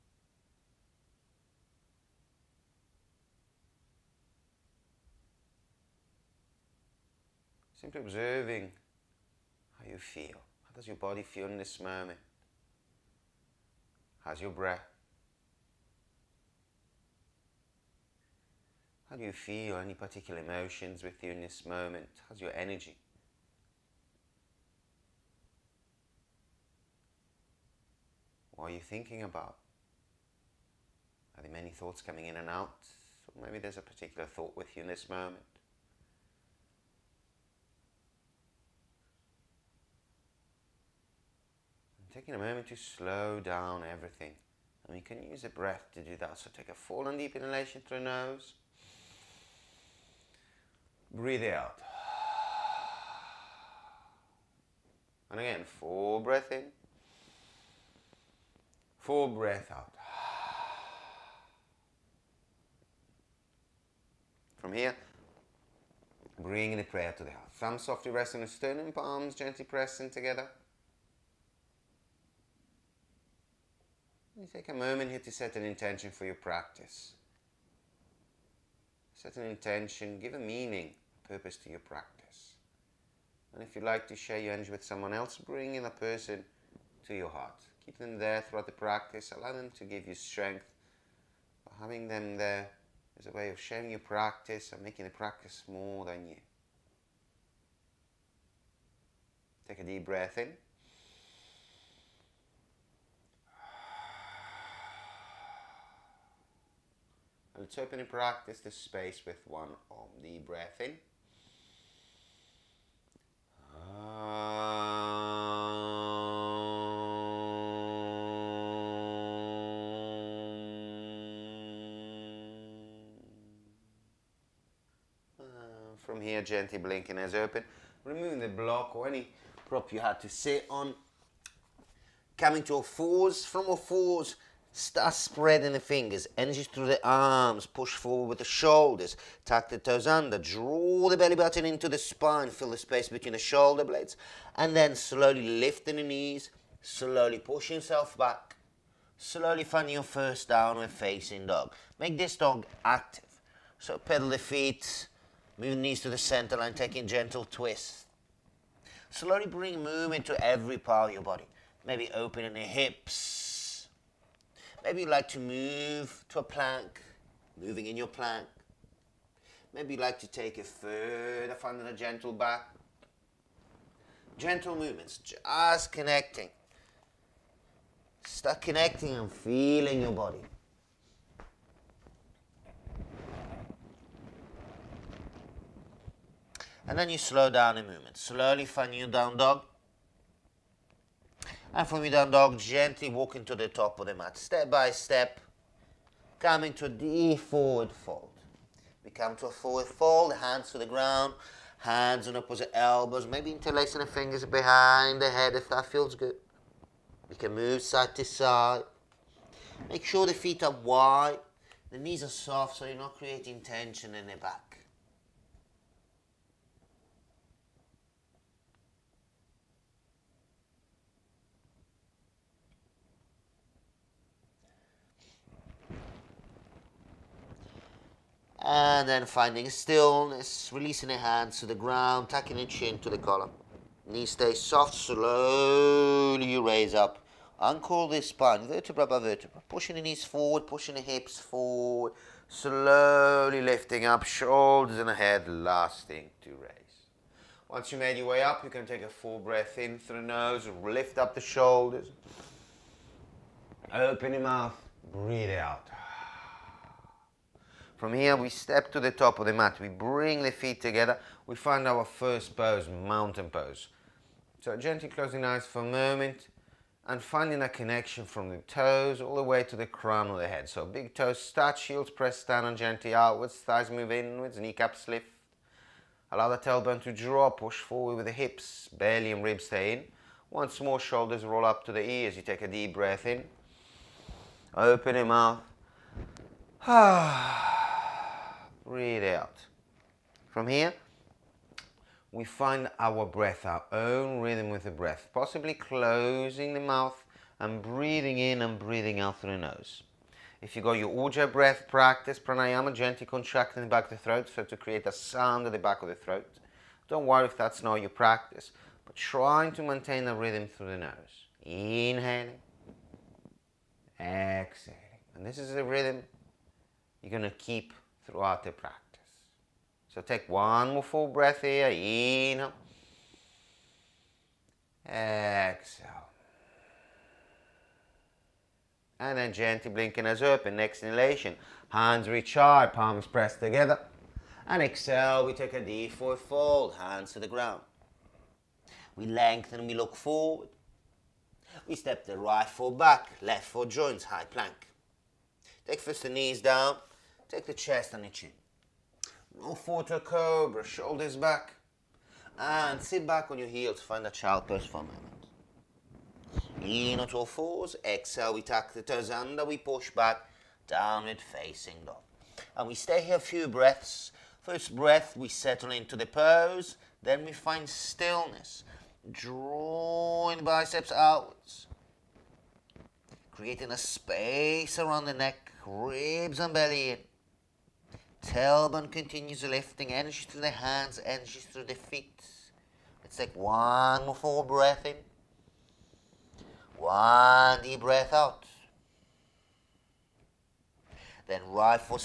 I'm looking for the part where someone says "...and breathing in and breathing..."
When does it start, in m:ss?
4:57.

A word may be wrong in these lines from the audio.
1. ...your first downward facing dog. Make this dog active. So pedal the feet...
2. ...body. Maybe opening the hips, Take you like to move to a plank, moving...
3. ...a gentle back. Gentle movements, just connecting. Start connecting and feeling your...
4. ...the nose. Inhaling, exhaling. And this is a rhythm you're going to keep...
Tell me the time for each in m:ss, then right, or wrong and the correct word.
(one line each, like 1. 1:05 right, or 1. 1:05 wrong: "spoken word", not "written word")
1. 2:29 right
2. 2:41 wrong: "Maybe", not "Take"
3. 2:51 right
4. 5:10 right.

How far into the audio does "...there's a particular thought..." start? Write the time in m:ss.
0:33.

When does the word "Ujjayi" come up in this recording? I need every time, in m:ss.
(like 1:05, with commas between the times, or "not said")
5:01.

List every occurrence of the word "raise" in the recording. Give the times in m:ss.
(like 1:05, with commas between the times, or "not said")
3:56, 4:06.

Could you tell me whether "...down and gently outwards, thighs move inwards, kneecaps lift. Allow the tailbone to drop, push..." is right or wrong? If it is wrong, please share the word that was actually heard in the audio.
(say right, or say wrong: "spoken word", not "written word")
right.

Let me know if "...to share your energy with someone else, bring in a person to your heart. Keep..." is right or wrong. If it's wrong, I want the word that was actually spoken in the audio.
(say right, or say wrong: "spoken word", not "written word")
right.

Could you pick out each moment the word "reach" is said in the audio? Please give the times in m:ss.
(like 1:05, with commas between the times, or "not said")
5:32.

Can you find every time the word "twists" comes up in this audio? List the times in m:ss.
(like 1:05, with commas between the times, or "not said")
2:37.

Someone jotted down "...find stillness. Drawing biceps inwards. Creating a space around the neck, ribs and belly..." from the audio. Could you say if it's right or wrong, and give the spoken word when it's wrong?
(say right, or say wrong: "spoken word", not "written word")
wrong: "outwards", not "inwards".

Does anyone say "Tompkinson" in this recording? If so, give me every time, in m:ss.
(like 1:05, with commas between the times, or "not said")
not said.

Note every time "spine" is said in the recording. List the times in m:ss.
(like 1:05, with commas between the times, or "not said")
2:21, 3:58.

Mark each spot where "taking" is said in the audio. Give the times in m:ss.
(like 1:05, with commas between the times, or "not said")
0:42, 2:36.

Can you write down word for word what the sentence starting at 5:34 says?
And exhale, we take a deep forward fold, hands to the ground.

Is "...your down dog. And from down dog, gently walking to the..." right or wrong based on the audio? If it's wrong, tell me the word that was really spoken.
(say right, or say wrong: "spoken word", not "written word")
right.